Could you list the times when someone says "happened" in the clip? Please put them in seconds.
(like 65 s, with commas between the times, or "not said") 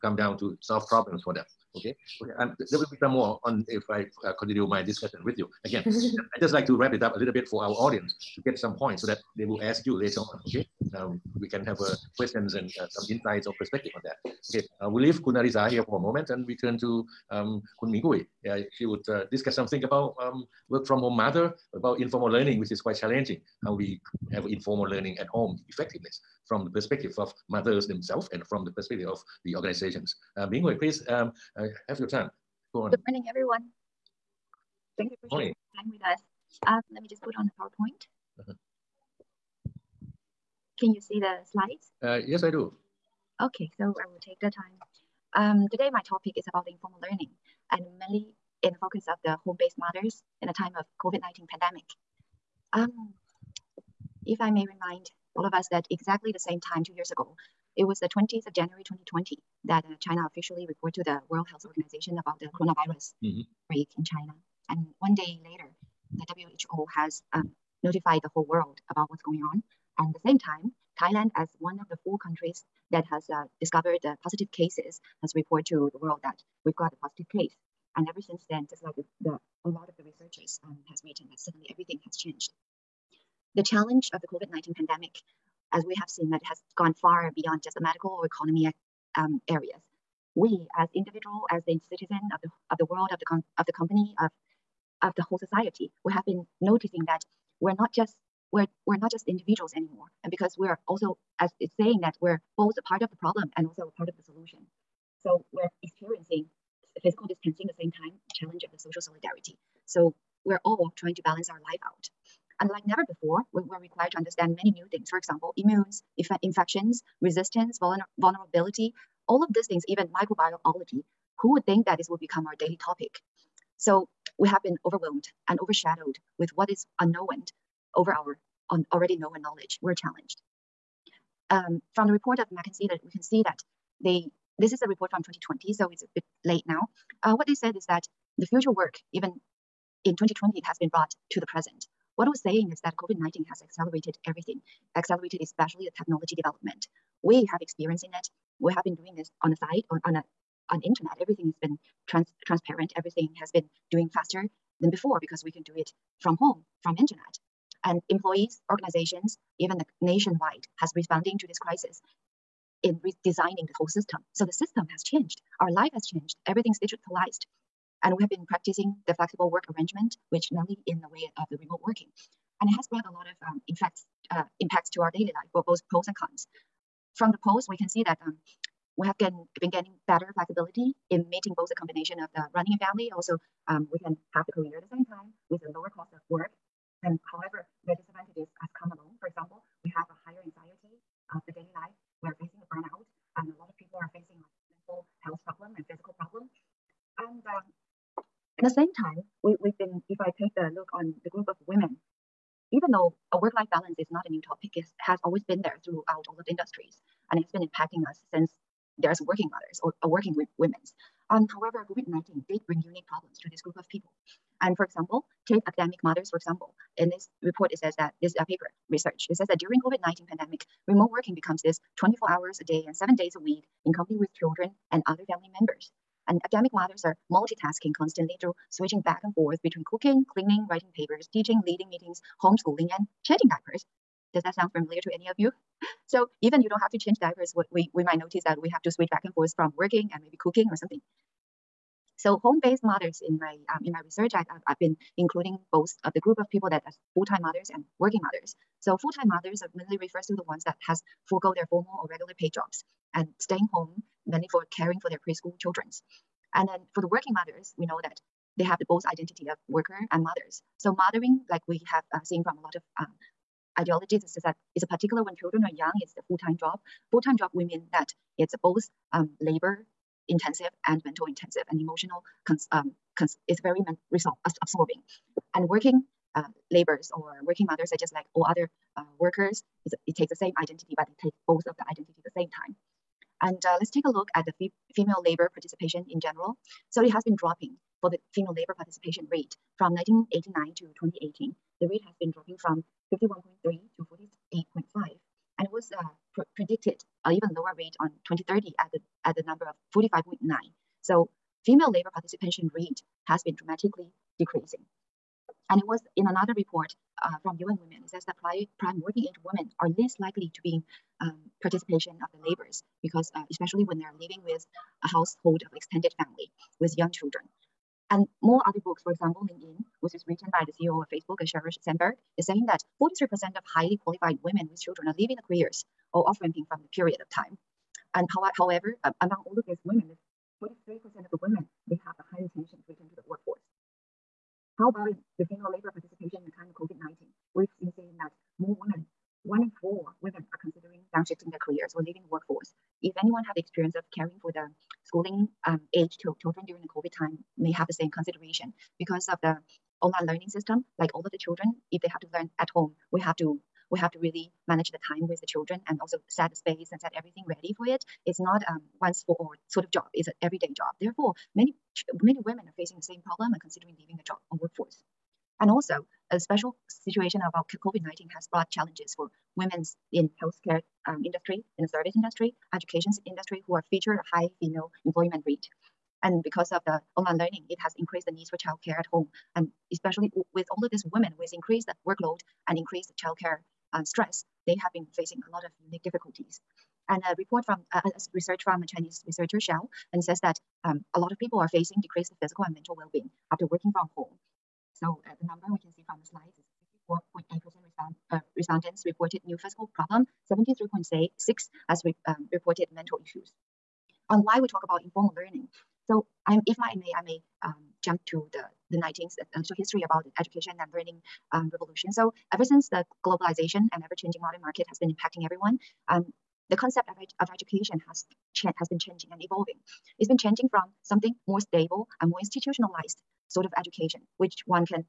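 not said.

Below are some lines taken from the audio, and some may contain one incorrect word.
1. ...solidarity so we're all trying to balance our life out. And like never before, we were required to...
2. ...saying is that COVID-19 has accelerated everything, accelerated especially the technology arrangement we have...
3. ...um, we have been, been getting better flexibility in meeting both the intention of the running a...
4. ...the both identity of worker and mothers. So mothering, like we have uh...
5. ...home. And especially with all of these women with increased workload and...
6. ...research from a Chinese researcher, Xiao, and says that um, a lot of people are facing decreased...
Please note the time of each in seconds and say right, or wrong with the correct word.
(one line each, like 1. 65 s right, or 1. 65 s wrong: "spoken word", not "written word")
1. 109 s right
2. 142 s wrong: "development", not "arrangement"
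3. 178 s wrong: "combination", not "intention"
4. 258 s right
5. 379 s right
6. 388 s right.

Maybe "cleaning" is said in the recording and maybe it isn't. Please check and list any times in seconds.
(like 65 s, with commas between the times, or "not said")
230 s.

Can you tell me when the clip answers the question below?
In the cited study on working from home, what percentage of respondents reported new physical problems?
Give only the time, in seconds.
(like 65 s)
397 s.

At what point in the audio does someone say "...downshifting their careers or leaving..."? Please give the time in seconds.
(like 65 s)
341 s.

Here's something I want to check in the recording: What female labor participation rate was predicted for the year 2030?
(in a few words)
45.9.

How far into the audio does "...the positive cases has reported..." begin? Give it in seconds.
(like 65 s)
74 s.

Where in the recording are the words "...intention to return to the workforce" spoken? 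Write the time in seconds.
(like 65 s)
332 s.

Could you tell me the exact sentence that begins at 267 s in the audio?
Full-time job, we mean that it's both um, labor intensive and mental intensive and emotional cons, um, cons it's very men- absorbing.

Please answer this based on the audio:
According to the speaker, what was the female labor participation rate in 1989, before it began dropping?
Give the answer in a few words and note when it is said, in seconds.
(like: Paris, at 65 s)
51.3, at 293 s.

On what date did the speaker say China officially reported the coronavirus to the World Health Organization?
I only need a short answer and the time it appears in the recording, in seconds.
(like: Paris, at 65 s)
20 January 2020, at 58 s.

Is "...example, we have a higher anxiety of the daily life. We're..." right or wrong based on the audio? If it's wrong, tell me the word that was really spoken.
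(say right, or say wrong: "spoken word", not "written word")
right.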